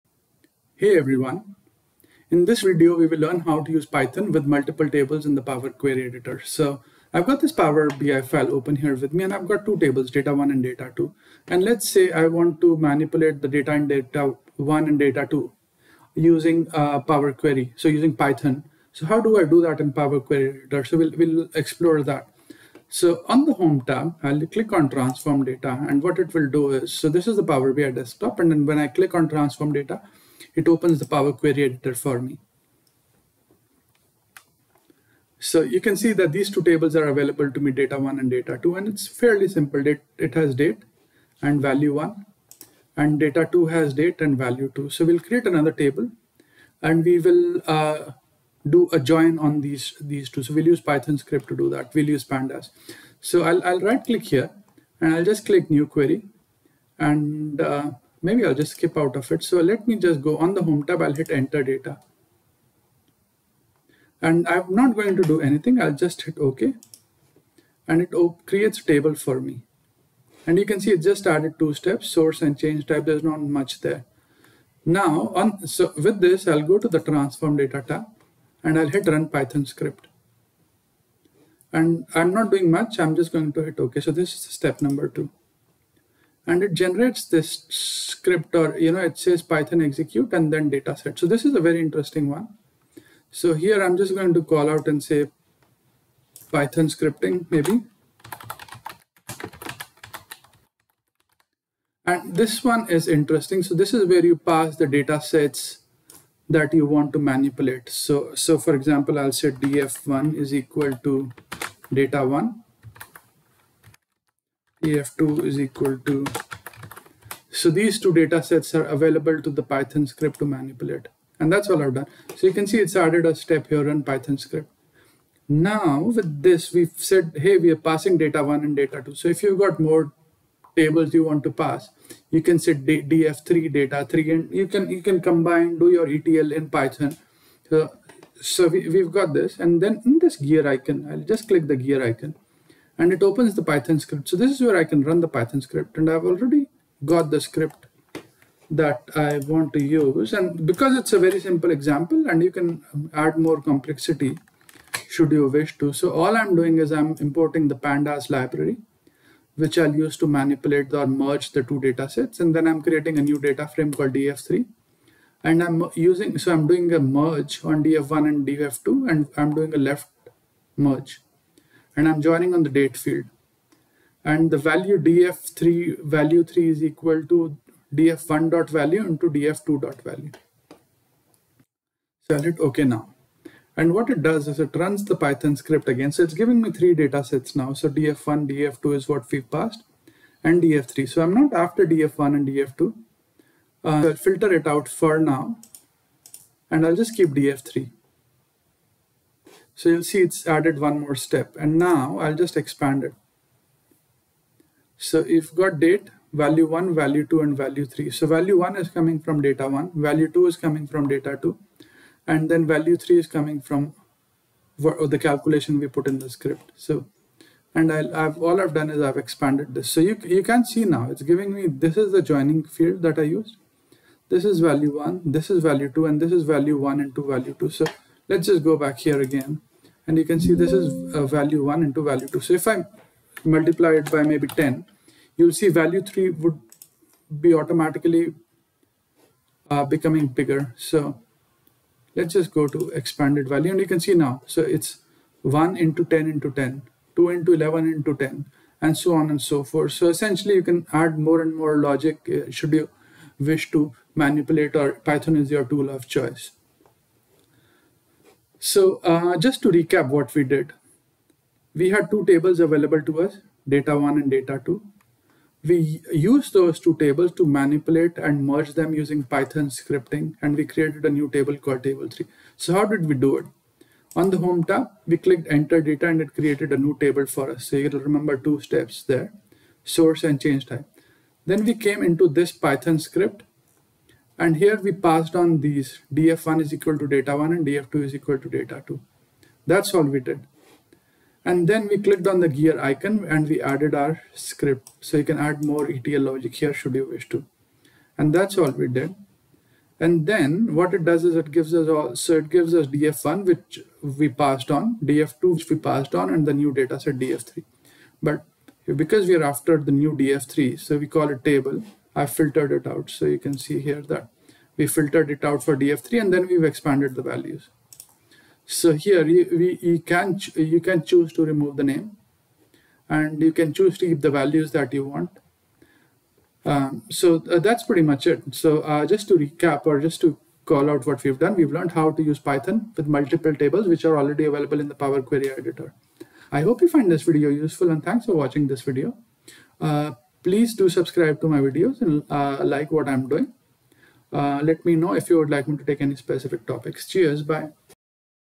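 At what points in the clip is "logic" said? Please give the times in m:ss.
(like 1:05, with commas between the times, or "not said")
4:11, 4:56.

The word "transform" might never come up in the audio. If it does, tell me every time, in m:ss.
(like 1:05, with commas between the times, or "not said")
0:24, 0:29, 1:16.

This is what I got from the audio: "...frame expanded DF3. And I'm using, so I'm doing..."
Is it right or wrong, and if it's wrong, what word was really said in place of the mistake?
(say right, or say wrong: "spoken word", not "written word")
wrong: "called", not "expanded".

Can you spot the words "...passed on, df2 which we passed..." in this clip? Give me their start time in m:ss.
5:04.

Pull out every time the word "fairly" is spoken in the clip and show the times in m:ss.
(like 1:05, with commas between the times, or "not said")
0:39.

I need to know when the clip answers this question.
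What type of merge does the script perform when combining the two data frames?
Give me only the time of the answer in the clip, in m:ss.
2:49.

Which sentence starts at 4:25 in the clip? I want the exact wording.
We used those two tables to manipulate and merge them using Python scripting, and we created a new table called table three.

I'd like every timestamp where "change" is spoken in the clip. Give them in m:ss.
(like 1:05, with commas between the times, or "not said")
1:12, 4:40.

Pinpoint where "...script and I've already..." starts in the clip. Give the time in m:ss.
2:25.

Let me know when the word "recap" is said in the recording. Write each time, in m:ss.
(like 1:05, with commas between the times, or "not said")
4:19, 5:29.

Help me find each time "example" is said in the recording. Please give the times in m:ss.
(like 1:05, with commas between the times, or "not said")
1:48, 2:31.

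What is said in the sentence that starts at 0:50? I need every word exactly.
So we'll use Python script to do that.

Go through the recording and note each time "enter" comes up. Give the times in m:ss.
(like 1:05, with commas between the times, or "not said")
1:01, 4:35.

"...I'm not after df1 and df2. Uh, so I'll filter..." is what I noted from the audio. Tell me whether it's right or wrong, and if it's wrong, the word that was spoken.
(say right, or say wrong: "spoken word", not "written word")
right.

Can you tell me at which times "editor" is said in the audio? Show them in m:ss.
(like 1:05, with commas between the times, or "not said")
0:06, 0:20, 0:31, 5:35.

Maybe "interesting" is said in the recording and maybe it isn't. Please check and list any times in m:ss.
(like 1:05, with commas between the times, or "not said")
1:31, 1:43.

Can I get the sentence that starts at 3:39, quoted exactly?
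So you, you can see now, it's giving me, this is the joining field that I used.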